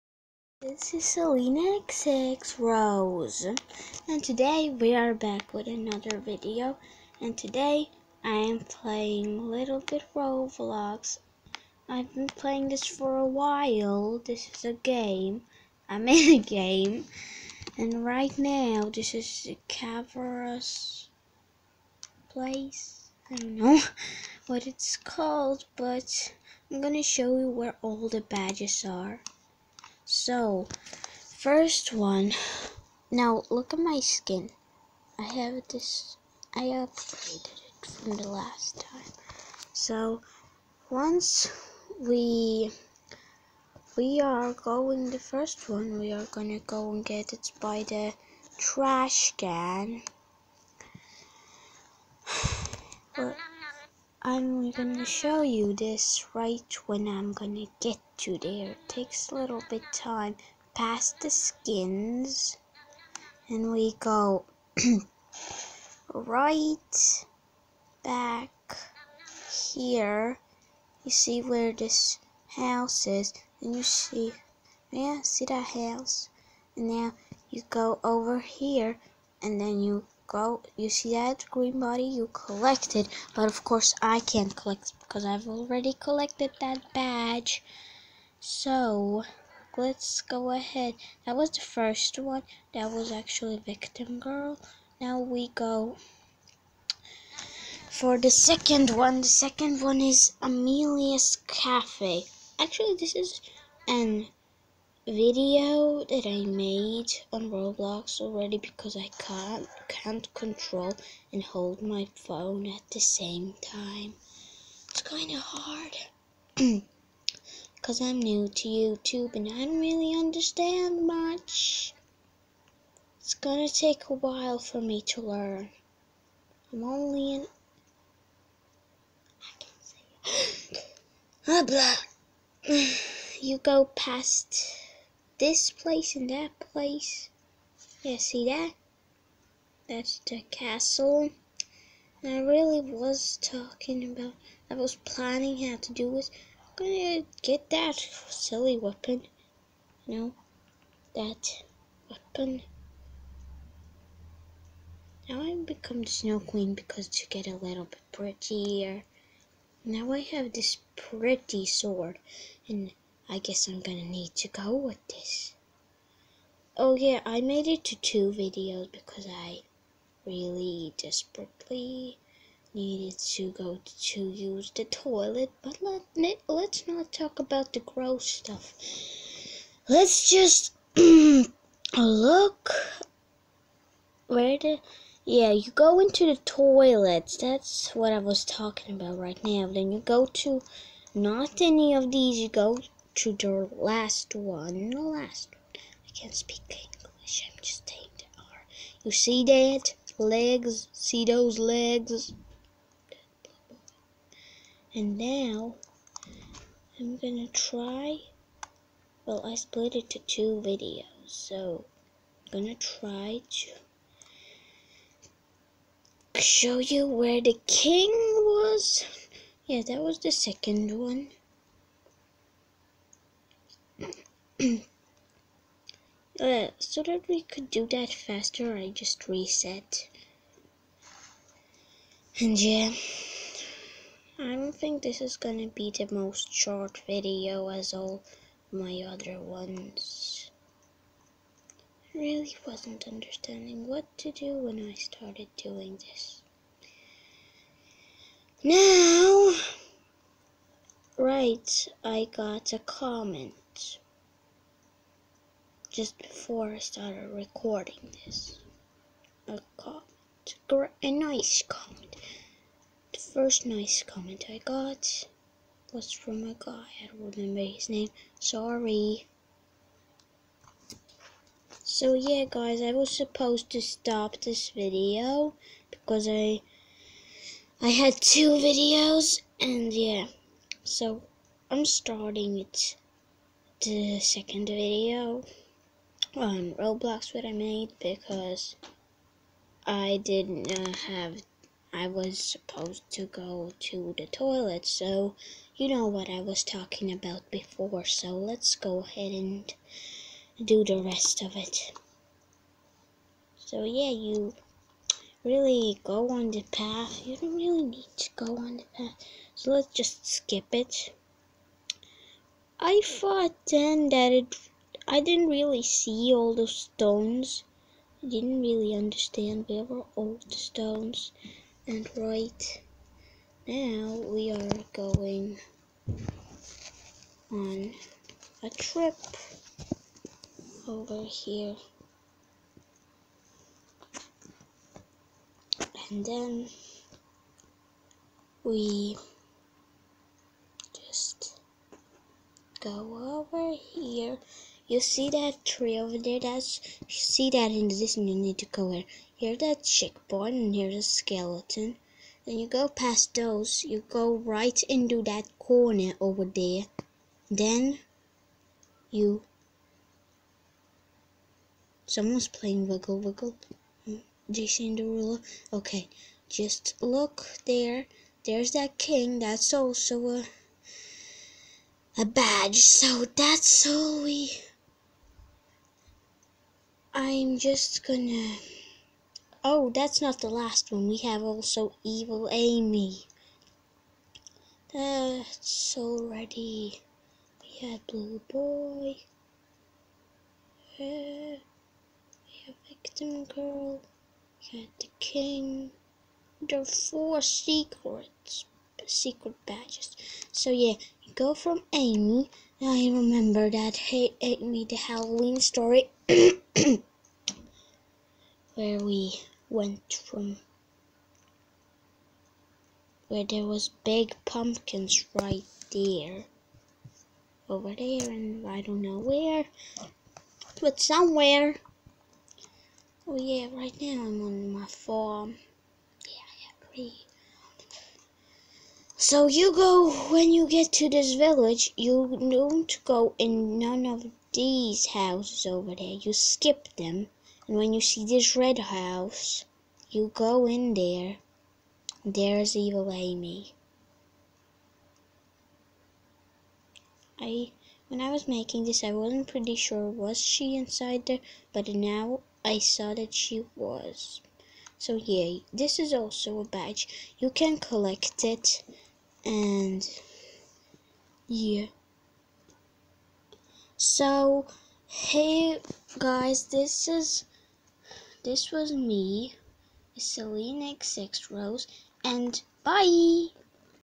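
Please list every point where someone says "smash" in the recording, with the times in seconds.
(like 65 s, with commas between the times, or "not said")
not said.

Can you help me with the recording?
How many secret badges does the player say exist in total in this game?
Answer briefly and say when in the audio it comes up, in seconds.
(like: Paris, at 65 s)
4, at 396 s.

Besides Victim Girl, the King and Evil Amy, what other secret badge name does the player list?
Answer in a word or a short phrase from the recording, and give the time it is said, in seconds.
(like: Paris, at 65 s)
Blue Boy, at 388 s.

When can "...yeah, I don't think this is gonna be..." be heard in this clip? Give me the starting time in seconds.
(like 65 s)
232 s.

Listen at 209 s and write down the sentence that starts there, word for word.
Well, I split it to two videos, so I'm gonna try to show you where the king was.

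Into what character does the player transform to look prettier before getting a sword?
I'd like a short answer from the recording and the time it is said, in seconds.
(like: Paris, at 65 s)
Snow Queen, at 156 s.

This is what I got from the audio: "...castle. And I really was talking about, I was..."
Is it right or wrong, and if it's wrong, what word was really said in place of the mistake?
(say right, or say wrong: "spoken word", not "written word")
right.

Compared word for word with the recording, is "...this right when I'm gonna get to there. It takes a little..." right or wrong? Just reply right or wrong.
right.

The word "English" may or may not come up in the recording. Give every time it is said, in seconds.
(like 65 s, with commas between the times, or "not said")
196 s.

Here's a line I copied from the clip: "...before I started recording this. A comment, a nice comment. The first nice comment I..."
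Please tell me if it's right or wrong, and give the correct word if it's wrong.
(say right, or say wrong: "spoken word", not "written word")
right.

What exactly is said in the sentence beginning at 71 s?
You see where this house is and you see, yeah, see that house?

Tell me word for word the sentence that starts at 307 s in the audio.
You don't really need to go on the path.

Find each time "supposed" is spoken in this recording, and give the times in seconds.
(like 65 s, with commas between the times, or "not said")
273 s, 292 s.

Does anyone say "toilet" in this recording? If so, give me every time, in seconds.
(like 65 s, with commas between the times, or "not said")
174 s, 186 s, 294 s.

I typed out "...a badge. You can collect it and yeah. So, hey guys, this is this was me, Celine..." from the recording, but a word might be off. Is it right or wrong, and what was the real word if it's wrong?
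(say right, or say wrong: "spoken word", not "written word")
right.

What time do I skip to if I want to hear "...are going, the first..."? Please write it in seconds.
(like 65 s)
44 s.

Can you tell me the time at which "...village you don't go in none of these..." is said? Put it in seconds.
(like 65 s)
431 s.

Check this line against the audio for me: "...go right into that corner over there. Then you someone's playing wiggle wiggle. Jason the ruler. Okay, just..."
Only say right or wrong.
right.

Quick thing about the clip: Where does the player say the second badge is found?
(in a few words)
Amelia's Cafe.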